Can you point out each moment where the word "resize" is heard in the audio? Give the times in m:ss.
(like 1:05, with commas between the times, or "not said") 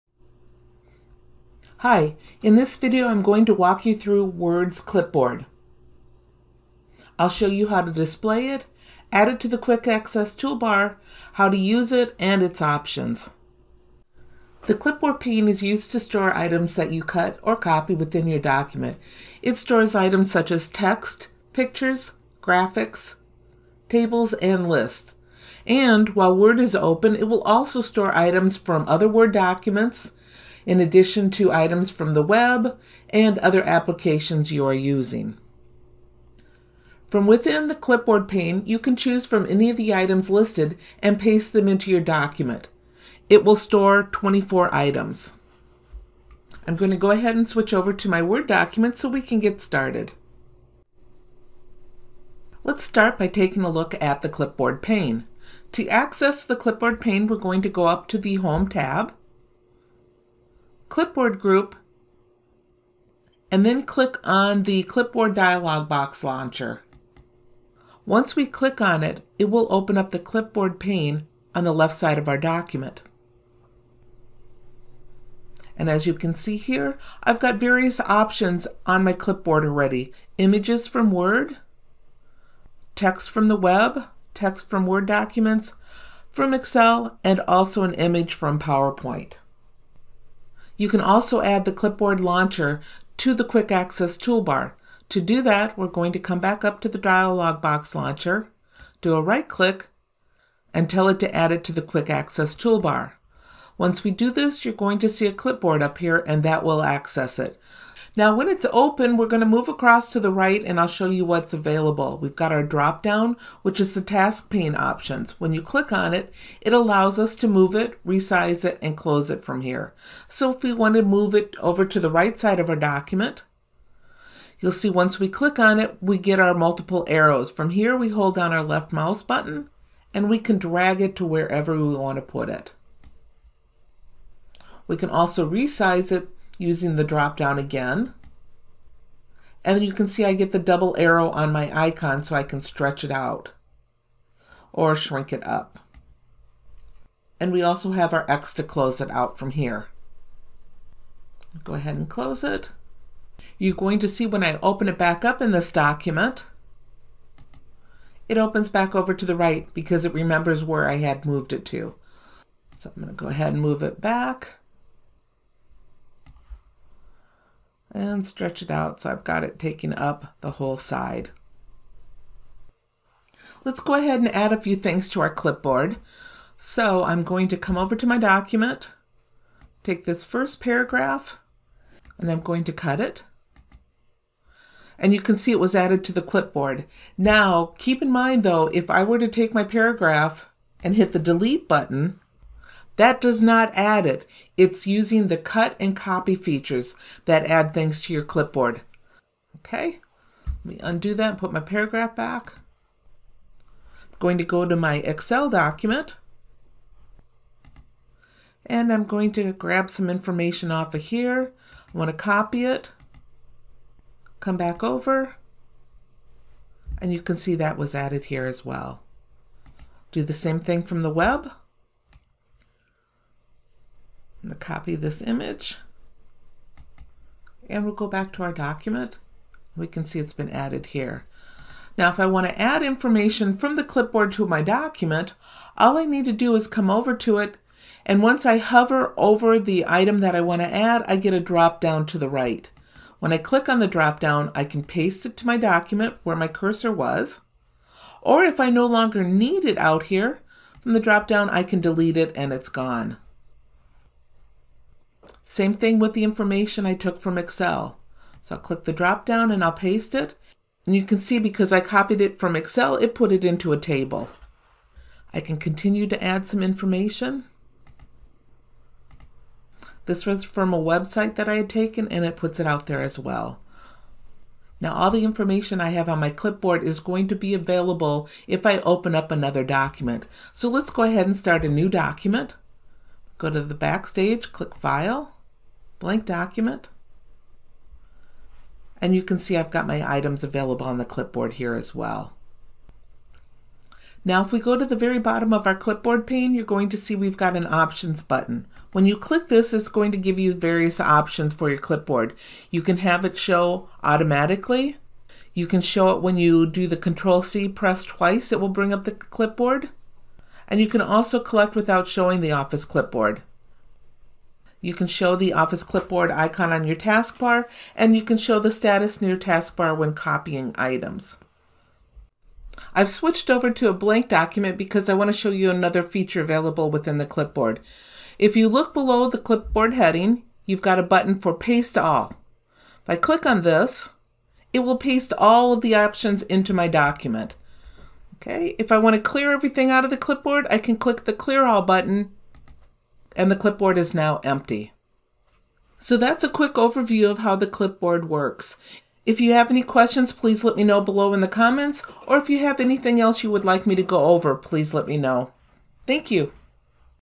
1:58, 2:15.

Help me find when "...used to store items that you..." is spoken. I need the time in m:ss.
0:15.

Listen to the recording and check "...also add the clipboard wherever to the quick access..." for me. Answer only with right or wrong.
wrong.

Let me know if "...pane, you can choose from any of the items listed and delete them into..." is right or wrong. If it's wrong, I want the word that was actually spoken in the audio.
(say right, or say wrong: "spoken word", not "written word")
wrong: "paste", not "delete".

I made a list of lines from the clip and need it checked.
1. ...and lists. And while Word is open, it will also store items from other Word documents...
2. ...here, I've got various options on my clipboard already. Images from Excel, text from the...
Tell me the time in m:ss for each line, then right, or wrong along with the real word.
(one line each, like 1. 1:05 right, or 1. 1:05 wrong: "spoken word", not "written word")
1. 0:24 right
2. 1:16 wrong: "Word", not "Excel".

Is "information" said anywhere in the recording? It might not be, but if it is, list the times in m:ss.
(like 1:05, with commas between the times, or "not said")
3:30, 3:52, 4:16, 4:26, 4:35.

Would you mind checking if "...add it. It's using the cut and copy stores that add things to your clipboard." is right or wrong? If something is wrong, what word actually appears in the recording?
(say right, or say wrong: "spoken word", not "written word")
wrong: "features", not "stores".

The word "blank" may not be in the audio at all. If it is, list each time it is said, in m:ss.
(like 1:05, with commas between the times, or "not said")
4:45, 5:23.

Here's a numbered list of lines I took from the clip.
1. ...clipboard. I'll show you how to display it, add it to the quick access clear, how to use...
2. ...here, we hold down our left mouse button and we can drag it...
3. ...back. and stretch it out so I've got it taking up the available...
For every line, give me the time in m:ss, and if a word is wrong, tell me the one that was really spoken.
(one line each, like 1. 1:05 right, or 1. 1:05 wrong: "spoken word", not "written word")
1. 0:04 wrong: "toolbar", not "clear"
2. 2:07 right
3. 2:43 wrong: "whole", not "available".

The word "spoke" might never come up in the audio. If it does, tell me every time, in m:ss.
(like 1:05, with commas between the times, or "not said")
not said.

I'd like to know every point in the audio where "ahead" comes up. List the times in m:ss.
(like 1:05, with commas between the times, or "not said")
0:47, 2:31, 2:43, 2:53, 4:41.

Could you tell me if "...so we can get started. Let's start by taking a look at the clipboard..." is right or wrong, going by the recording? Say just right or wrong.
right.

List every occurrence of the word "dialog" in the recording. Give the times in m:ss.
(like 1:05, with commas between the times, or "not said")
1:05, 1:36.